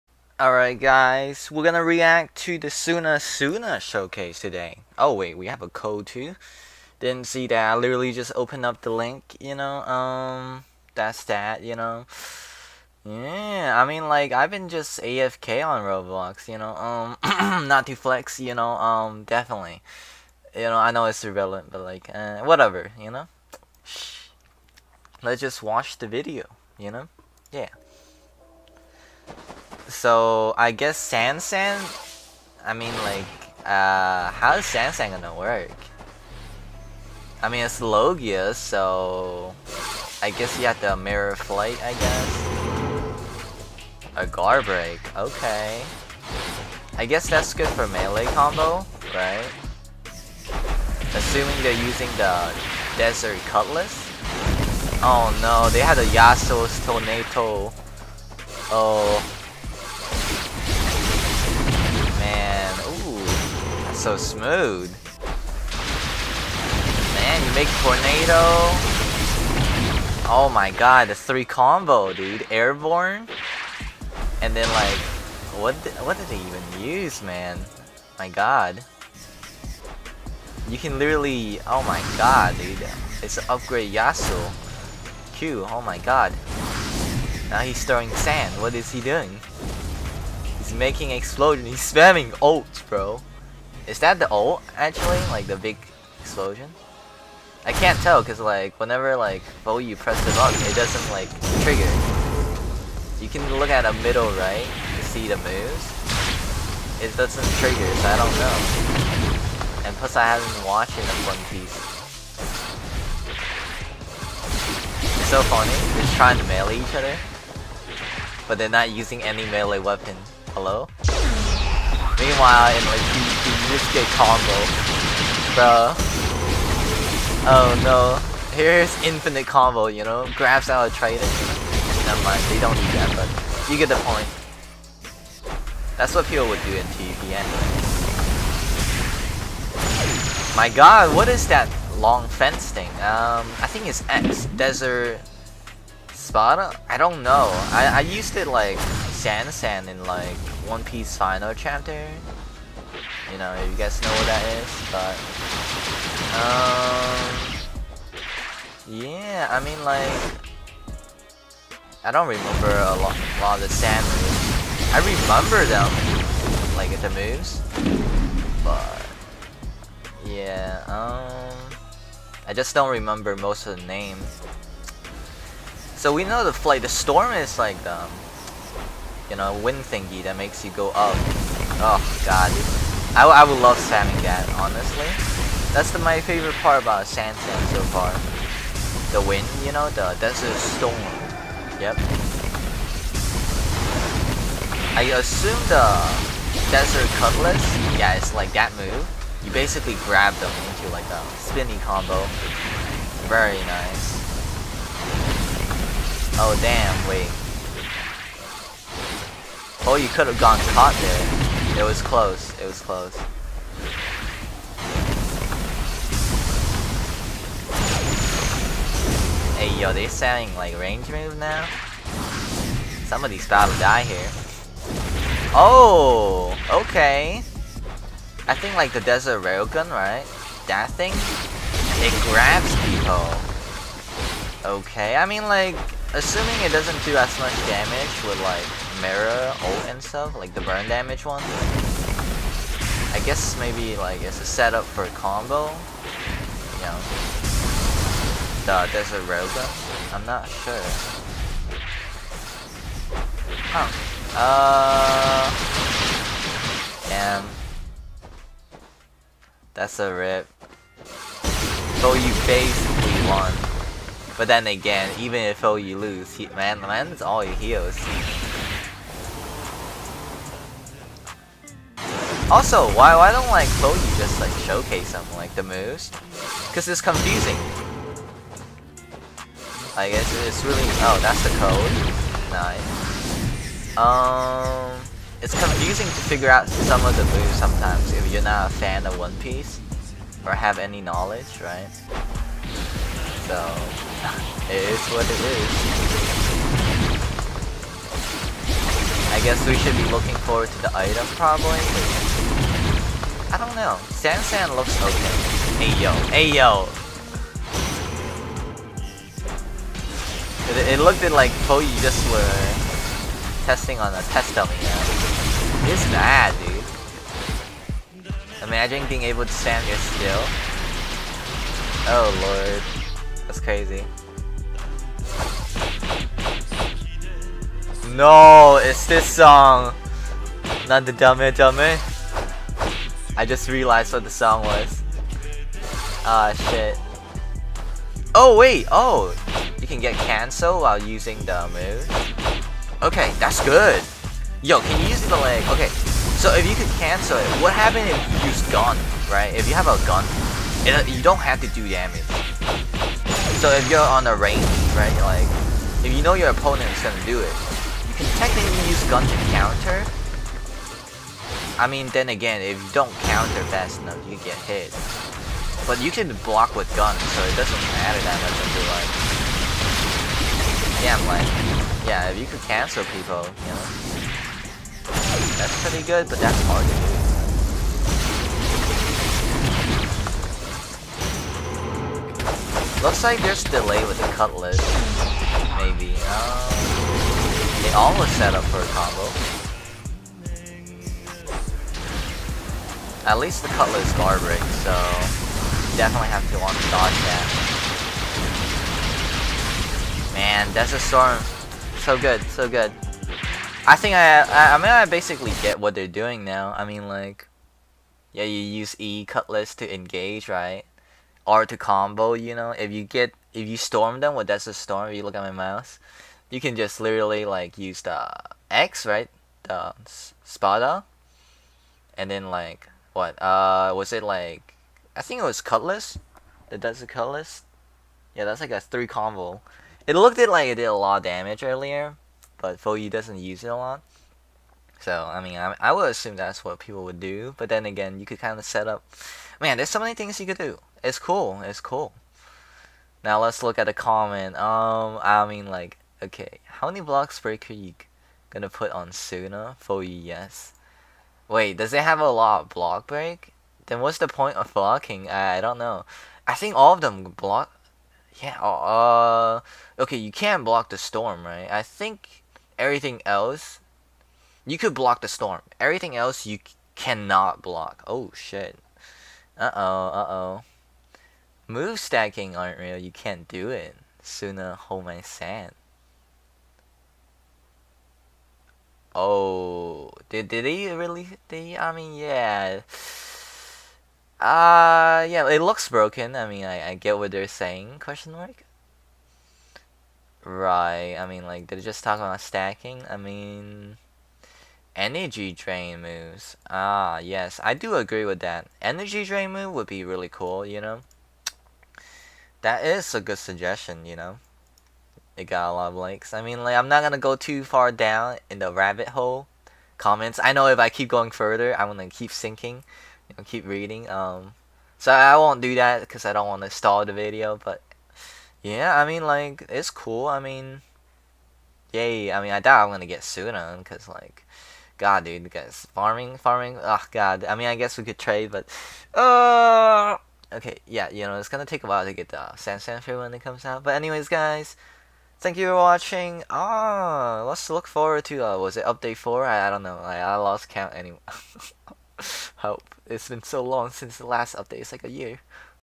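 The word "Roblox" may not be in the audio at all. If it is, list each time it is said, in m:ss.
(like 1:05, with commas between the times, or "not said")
0:15.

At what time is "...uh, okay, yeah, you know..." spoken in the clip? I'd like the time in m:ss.
8:49.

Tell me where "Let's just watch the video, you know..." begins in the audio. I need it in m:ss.
0:25.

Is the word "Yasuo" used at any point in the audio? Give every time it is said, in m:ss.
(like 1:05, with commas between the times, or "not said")
0:56, 1:23.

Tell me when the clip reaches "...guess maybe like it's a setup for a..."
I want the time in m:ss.
4:03.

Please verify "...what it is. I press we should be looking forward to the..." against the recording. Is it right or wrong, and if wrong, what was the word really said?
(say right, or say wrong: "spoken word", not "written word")
wrong: "guess", not "press".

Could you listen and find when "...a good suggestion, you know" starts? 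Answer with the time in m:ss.
8:23.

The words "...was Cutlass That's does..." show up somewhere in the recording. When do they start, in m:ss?
7:05.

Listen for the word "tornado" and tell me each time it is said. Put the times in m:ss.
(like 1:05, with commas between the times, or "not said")
0:56, 1:07.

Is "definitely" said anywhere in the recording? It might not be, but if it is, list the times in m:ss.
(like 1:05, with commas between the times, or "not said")
0:19, 6:35.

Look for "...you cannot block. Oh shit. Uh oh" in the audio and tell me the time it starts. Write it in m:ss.
7:46.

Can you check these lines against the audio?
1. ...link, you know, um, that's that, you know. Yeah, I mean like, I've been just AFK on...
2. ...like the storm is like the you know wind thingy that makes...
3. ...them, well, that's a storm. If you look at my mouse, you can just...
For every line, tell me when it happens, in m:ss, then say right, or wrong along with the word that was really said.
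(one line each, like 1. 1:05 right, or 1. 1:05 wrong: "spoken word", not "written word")
1. 0:08 right
2. 2:56 right
3. 6:54 right.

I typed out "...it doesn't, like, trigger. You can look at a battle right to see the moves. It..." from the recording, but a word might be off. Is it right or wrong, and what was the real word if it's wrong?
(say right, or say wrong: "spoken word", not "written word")
wrong: "middle", not "battle".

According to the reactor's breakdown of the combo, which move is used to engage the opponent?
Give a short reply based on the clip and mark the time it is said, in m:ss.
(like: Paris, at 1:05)
E cutlass, at 6:48.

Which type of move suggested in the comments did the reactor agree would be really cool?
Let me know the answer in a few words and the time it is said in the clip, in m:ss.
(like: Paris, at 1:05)
Energy drain moves, at 8:14.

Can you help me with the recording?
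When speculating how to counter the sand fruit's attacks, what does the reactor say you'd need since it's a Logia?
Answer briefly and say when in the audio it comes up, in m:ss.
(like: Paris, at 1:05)
Mirror flight, at 0:40.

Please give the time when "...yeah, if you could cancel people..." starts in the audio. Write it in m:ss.
6:12.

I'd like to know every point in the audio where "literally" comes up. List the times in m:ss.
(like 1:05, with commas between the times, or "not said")
0:07, 1:20, 6:56.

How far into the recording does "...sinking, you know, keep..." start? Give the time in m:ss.
8:32.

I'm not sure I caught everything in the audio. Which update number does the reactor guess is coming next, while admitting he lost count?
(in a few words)
4.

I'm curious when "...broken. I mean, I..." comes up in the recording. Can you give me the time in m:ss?
8:05.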